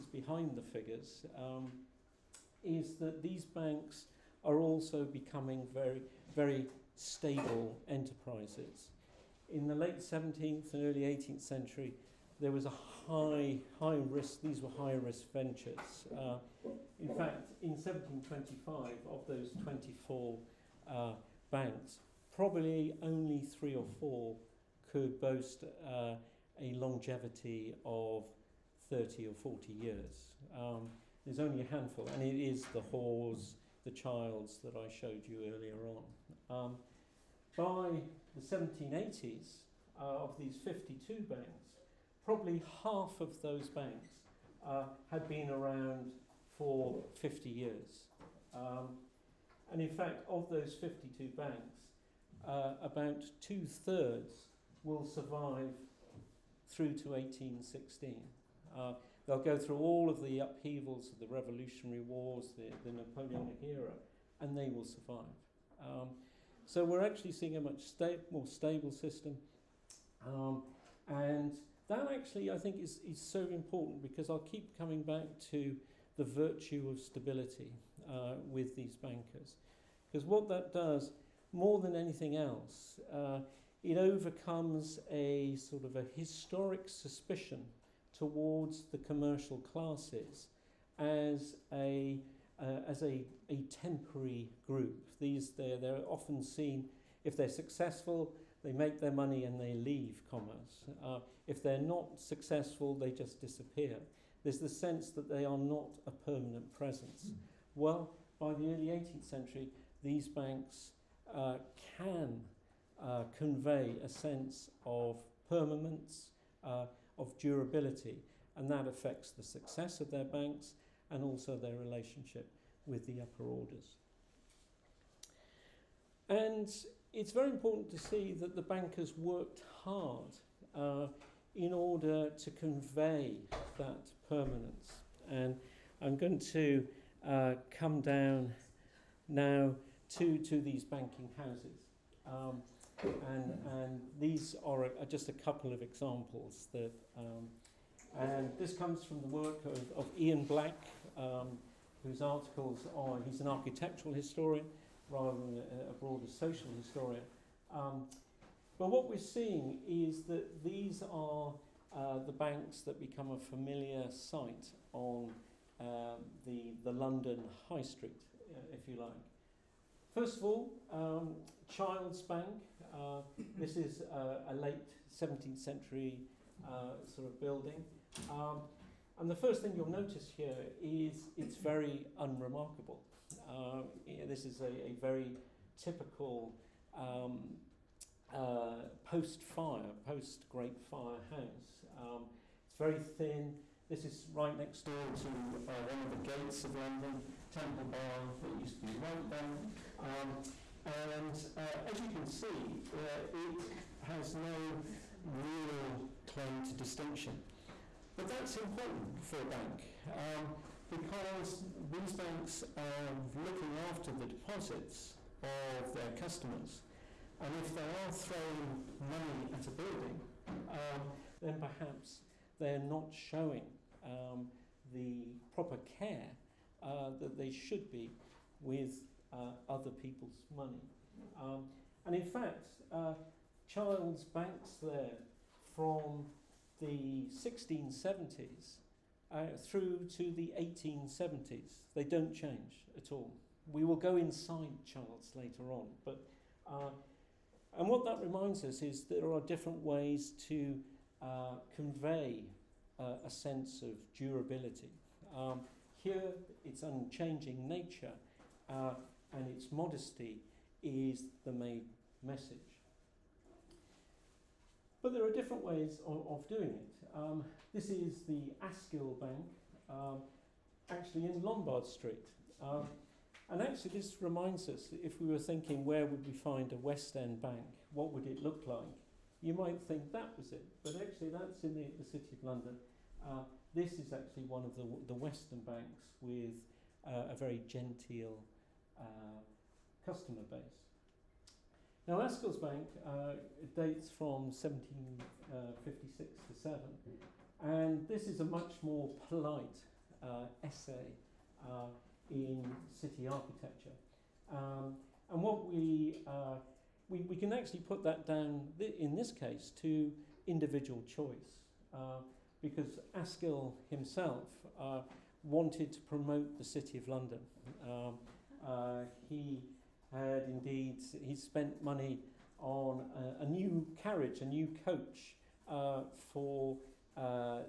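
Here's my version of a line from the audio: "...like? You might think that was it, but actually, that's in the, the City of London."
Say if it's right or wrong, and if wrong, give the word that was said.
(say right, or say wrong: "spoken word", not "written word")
right.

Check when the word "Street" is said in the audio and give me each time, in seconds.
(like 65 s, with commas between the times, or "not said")
167 s, 271 s.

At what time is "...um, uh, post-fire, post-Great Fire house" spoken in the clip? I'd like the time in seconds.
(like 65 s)
186 s.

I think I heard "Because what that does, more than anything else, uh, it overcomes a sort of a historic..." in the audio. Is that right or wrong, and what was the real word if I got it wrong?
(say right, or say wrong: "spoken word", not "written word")
right.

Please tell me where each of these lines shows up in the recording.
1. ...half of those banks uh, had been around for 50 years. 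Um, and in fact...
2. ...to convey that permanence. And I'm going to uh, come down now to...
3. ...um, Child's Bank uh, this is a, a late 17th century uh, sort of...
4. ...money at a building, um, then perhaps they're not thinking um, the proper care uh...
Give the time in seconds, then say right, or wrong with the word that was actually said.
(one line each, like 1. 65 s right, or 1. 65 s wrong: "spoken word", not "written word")
1. 42 s right
2. 132 s right
3. 170 s right
4. 219 s wrong: "showing", not "thinking".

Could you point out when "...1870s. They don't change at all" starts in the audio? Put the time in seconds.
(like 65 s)
240 s.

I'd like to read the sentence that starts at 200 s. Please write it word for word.
Um, and uh, as you can see, uh, it has no real claim to distinction.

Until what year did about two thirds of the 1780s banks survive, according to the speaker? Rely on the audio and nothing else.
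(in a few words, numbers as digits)
1816.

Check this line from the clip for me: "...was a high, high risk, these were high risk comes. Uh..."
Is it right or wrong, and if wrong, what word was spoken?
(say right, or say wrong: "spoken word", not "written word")
wrong: "ventures", not "comes".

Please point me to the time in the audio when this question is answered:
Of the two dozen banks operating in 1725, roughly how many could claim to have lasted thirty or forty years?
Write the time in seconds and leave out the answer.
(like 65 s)
23 s.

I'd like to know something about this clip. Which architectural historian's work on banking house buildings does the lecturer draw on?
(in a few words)
Ian Black.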